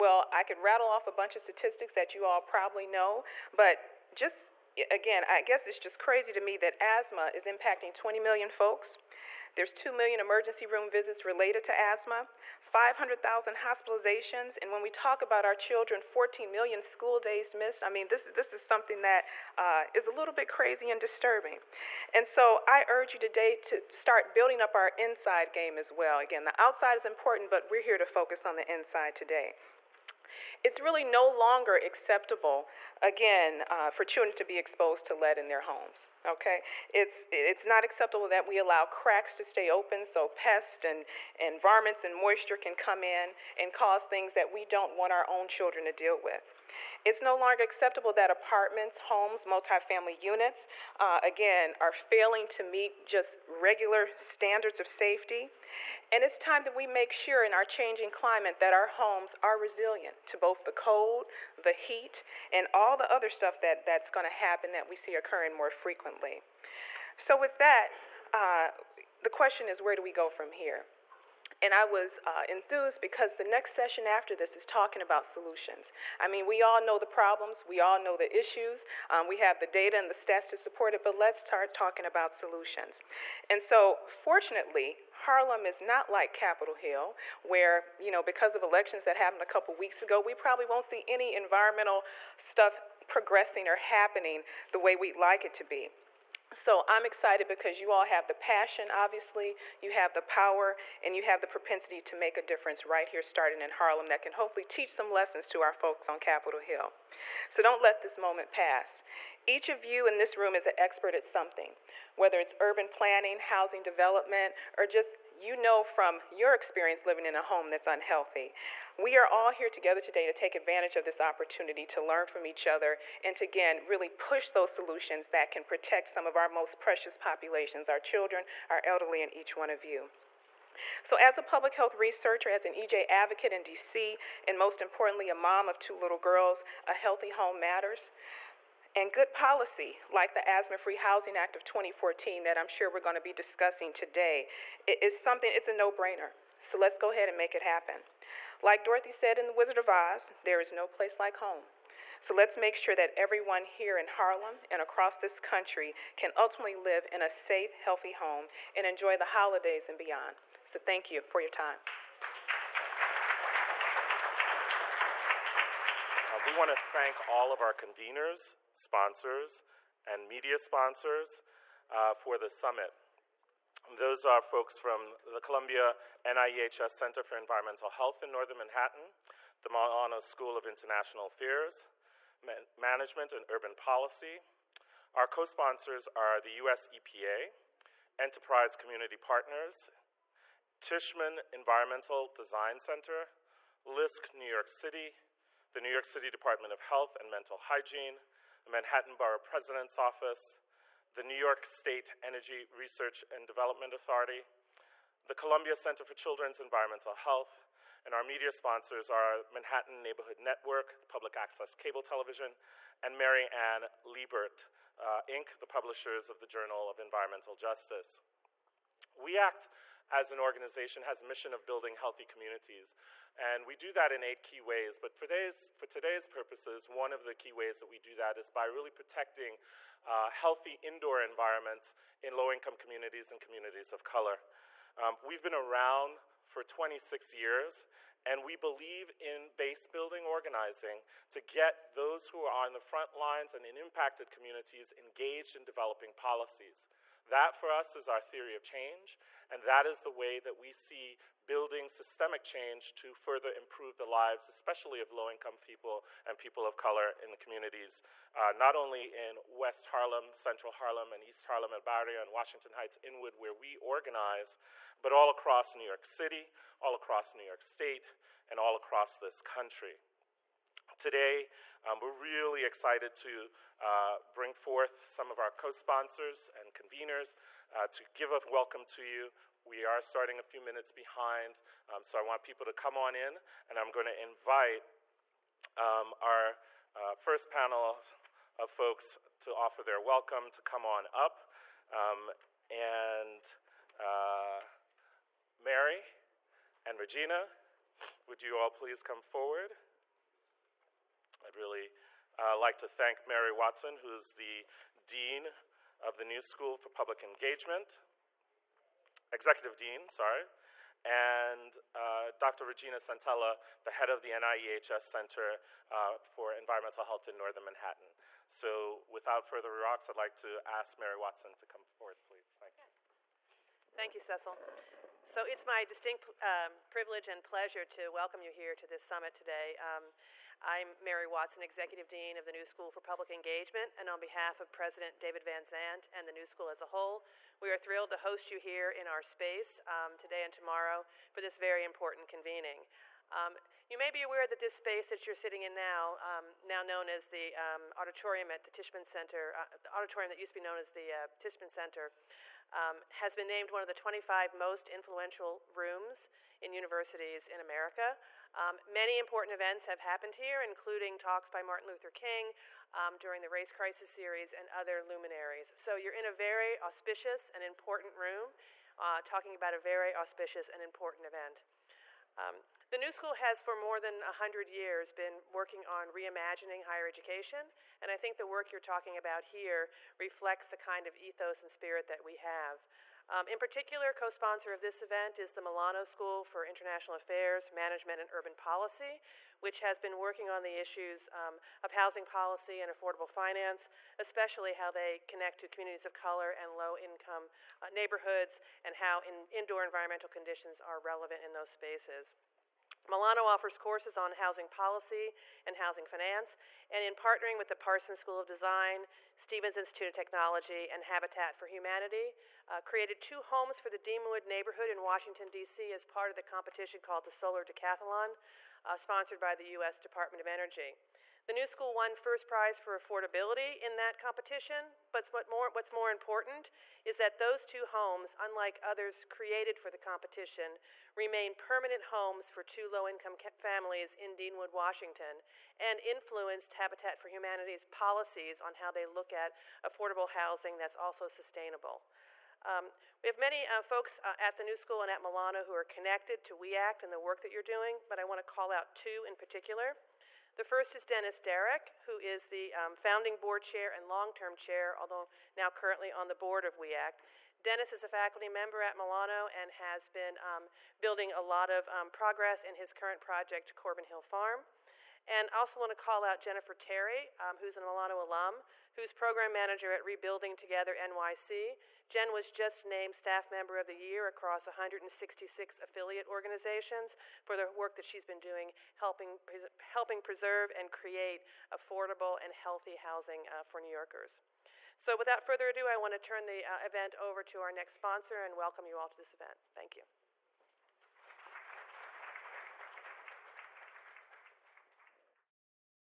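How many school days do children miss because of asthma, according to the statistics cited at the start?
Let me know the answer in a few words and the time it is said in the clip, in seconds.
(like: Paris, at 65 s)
14 million, at 16 s.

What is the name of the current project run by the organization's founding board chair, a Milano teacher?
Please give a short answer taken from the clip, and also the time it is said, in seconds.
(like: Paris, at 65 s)
Corbin Hill Farm, at 463 s.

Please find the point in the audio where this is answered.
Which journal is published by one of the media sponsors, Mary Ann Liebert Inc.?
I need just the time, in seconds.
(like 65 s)
216 s.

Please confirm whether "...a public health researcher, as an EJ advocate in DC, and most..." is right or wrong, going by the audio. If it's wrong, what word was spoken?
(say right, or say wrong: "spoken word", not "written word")
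right.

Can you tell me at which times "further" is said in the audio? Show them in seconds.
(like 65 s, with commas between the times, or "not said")
253 s, 319 s, 485 s.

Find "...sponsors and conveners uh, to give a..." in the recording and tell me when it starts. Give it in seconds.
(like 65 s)
275 s.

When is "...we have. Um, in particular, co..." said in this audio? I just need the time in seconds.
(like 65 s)
382 s.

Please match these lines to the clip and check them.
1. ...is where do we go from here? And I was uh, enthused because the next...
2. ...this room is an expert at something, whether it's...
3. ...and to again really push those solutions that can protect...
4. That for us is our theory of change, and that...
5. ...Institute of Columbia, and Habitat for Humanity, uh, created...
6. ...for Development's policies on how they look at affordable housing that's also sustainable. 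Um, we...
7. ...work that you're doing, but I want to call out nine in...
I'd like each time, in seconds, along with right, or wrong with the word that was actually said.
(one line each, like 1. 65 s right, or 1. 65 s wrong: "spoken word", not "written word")
1. 69 s right
2. 110 s right
3. 123 s right
4. 247 s right
5. 409 s wrong: "Technology", not "Columbia"
6. 437 s wrong: "Humanity", not "Development"
7. 447 s wrong: "two", not "nine".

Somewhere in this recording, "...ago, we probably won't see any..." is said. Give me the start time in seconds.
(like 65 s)
90 s.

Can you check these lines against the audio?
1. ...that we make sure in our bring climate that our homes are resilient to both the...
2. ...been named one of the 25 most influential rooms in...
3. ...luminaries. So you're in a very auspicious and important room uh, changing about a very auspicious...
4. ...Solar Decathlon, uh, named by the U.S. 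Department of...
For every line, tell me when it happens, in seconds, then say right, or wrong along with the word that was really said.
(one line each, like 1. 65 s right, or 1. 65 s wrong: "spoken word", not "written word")
1. 56 s wrong: "changing", not "bring"
2. 353 s right
3. 365 s wrong: "talking", not "changing"
4. 417 s wrong: "sponsored", not "named".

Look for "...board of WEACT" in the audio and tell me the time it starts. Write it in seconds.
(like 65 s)
456 s.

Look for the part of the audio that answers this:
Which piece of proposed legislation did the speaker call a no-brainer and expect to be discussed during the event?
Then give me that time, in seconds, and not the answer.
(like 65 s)
140 s.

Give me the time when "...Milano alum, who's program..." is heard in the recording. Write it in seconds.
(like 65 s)
467 s.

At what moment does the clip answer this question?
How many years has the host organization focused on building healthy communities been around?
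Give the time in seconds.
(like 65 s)
236 s.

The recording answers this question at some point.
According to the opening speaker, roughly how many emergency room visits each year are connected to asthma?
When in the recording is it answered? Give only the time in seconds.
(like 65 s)
9 s.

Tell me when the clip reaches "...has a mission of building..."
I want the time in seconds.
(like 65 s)
221 s.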